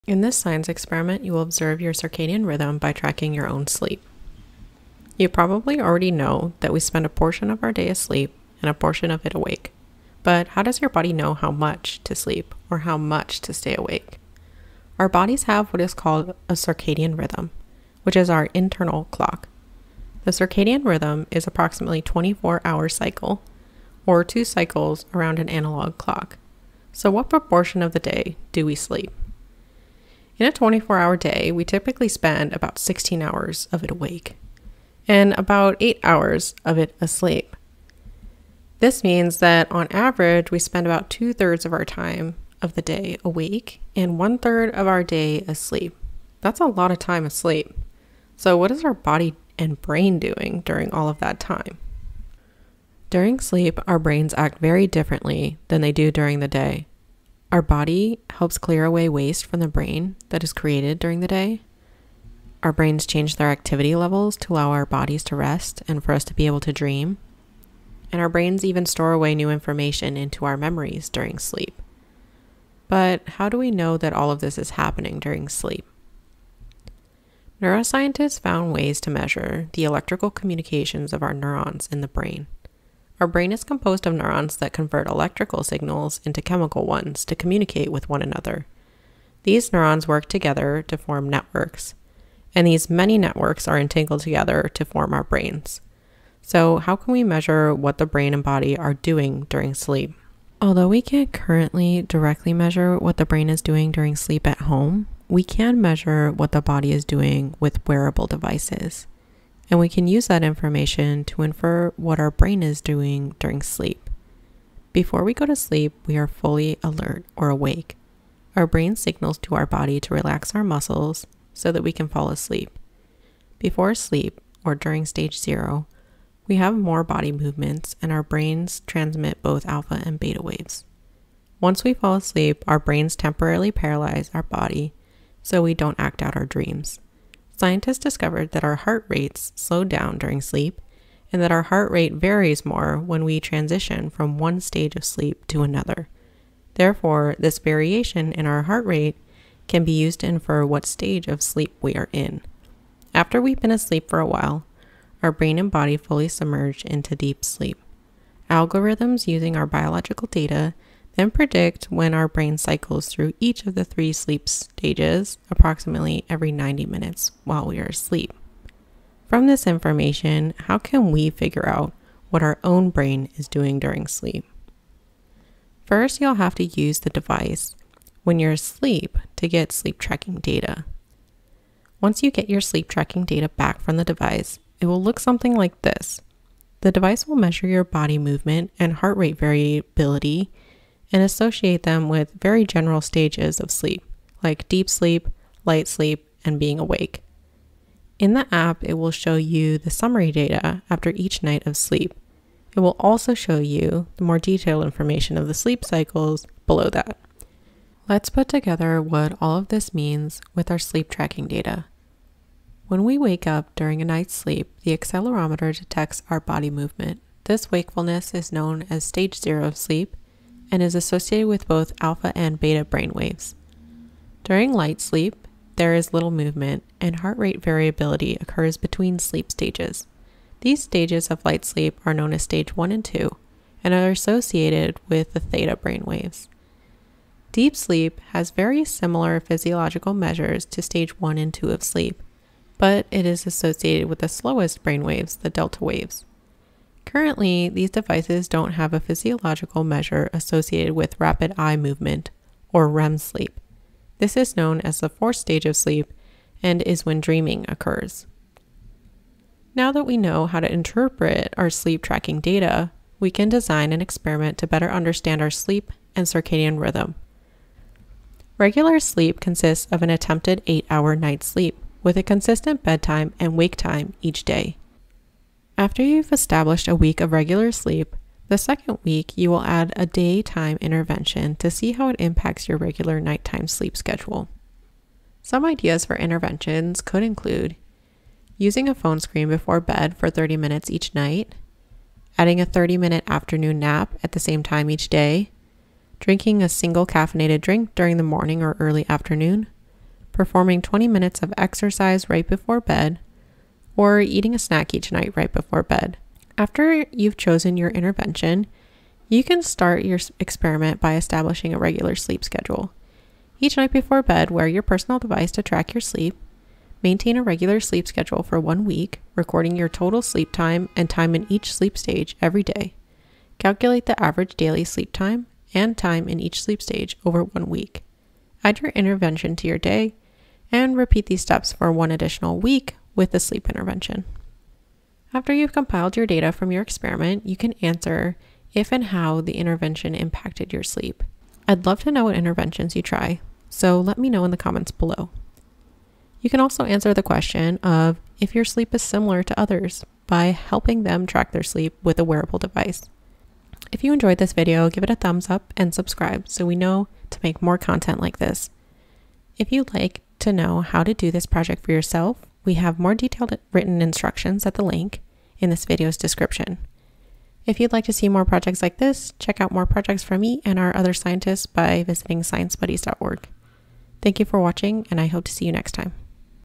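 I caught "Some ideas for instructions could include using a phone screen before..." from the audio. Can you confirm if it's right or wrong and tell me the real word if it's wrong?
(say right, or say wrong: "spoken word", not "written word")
wrong: "interventions", not "instructions".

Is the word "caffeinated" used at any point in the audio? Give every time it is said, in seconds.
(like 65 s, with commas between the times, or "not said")
297 s.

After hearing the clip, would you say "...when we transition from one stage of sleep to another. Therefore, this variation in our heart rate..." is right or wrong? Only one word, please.
right.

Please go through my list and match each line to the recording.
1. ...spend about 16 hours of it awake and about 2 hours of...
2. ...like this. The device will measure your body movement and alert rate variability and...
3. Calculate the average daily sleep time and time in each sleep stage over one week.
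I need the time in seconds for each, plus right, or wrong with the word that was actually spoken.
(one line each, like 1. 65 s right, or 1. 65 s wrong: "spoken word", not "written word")
1. 32 s wrong: "8", not "2"
2. 185 s wrong: "heart", not "alert"
3. 323 s right.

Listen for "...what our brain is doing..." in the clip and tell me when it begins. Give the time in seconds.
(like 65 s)
111 s.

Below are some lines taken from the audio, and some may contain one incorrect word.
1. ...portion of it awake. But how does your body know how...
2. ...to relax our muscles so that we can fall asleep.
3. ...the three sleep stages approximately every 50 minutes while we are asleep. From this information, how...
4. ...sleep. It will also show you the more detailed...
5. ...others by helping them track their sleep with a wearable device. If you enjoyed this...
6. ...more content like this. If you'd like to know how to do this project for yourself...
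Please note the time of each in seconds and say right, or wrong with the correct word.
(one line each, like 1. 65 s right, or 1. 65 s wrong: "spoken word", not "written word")
1. 8 s right
2. 120 s right
3. 163 s wrong: "90", not "50"
4. 201 s right
5. 349 s right
6. 357 s right.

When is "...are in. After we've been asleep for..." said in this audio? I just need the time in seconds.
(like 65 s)
151 s.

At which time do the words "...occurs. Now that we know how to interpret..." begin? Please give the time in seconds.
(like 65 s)
257 s.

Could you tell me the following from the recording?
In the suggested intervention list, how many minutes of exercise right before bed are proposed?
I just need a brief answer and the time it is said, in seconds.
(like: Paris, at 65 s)
20 minutes, at 300 s.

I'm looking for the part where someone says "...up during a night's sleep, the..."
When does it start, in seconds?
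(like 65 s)
213 s.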